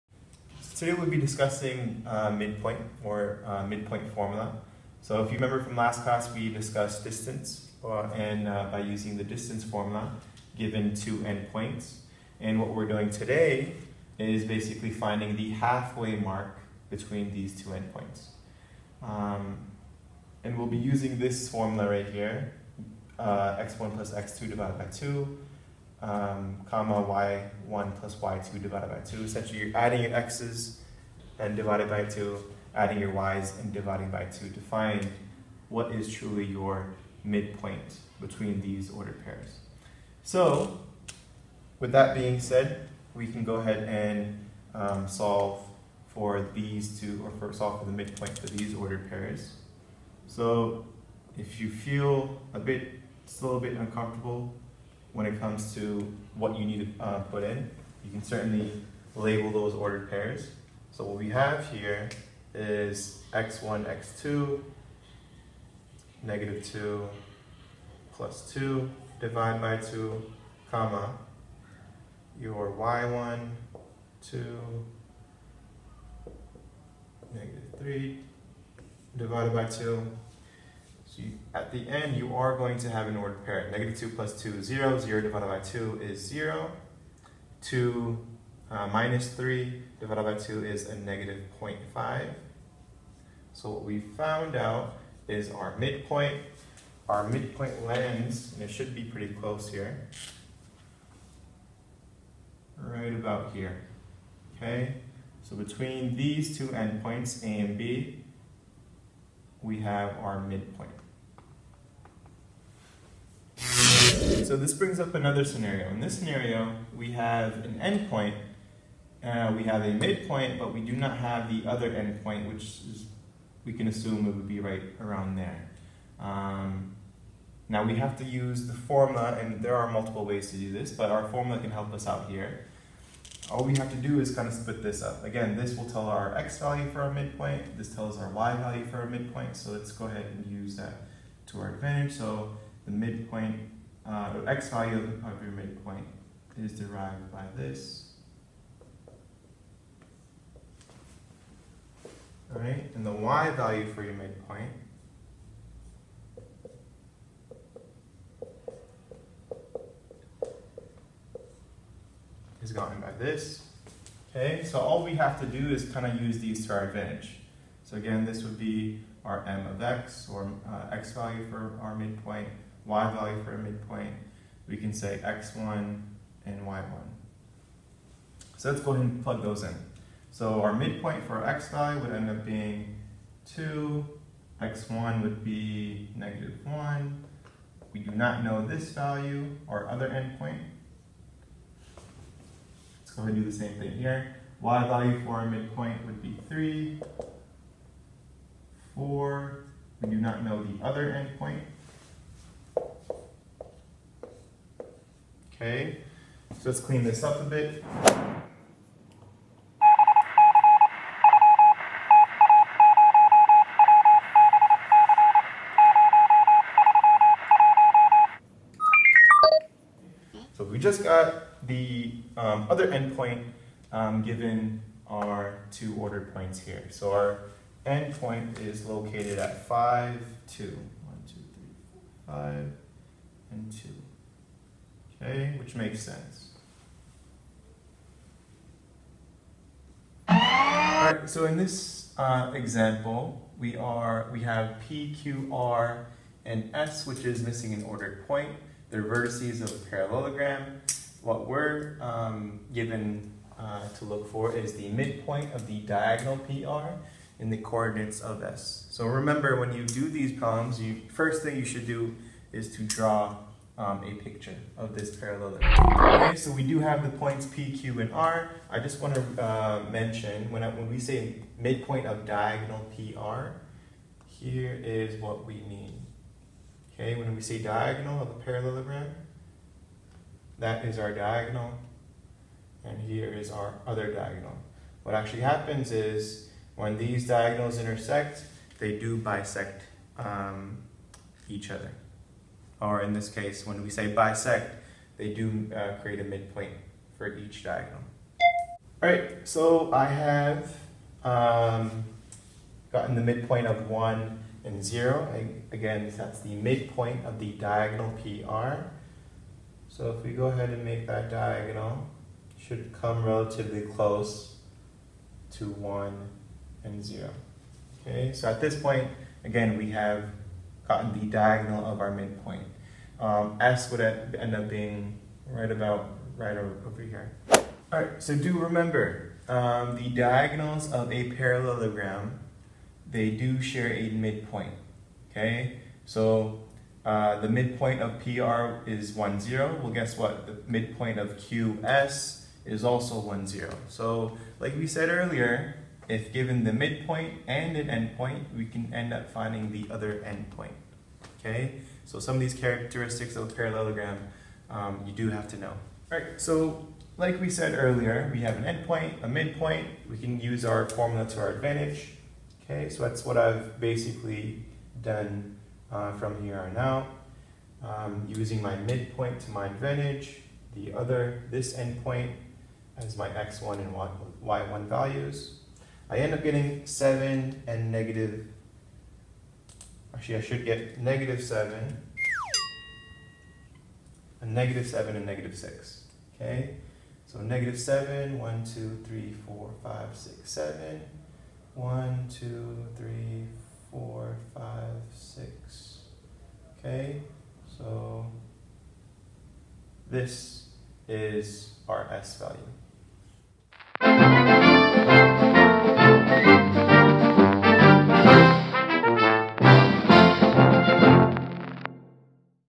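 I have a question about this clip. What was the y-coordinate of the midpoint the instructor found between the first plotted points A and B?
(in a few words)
-0.5.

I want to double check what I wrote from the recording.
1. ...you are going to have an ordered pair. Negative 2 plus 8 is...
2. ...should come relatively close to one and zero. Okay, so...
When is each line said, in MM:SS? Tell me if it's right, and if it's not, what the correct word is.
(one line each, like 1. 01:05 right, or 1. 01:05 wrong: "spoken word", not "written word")
1. 01:22 wrong: "2", not "8"
2. 05:12 right.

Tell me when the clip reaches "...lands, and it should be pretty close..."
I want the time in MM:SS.
01:37.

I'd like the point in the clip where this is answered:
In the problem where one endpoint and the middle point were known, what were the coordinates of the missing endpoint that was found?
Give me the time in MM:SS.
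03:49.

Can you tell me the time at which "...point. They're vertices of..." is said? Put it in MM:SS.
04:08.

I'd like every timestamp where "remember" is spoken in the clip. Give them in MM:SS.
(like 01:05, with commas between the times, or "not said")
00:05, 04:19, 05:28.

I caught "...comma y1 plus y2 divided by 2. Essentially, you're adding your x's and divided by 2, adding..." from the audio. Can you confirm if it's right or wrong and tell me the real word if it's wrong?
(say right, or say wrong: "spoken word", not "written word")
right.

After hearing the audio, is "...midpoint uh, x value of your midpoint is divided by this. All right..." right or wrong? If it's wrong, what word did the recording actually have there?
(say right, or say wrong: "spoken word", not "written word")
wrong: "derived", not "divided".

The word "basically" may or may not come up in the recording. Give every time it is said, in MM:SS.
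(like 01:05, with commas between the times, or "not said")
00:14, 06:03.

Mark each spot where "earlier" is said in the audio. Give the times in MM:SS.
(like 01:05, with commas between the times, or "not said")
05:45, 05:57.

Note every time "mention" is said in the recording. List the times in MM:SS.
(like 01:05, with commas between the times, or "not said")
04:29.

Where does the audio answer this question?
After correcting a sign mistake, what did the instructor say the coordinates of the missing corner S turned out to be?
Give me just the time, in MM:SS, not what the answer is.
06:24.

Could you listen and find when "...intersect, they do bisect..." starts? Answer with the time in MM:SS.
04:47.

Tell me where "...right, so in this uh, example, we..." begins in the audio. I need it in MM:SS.
04:00.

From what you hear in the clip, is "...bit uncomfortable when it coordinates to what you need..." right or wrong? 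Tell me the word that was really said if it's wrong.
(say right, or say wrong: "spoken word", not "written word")
wrong: "comes", not "coordinates".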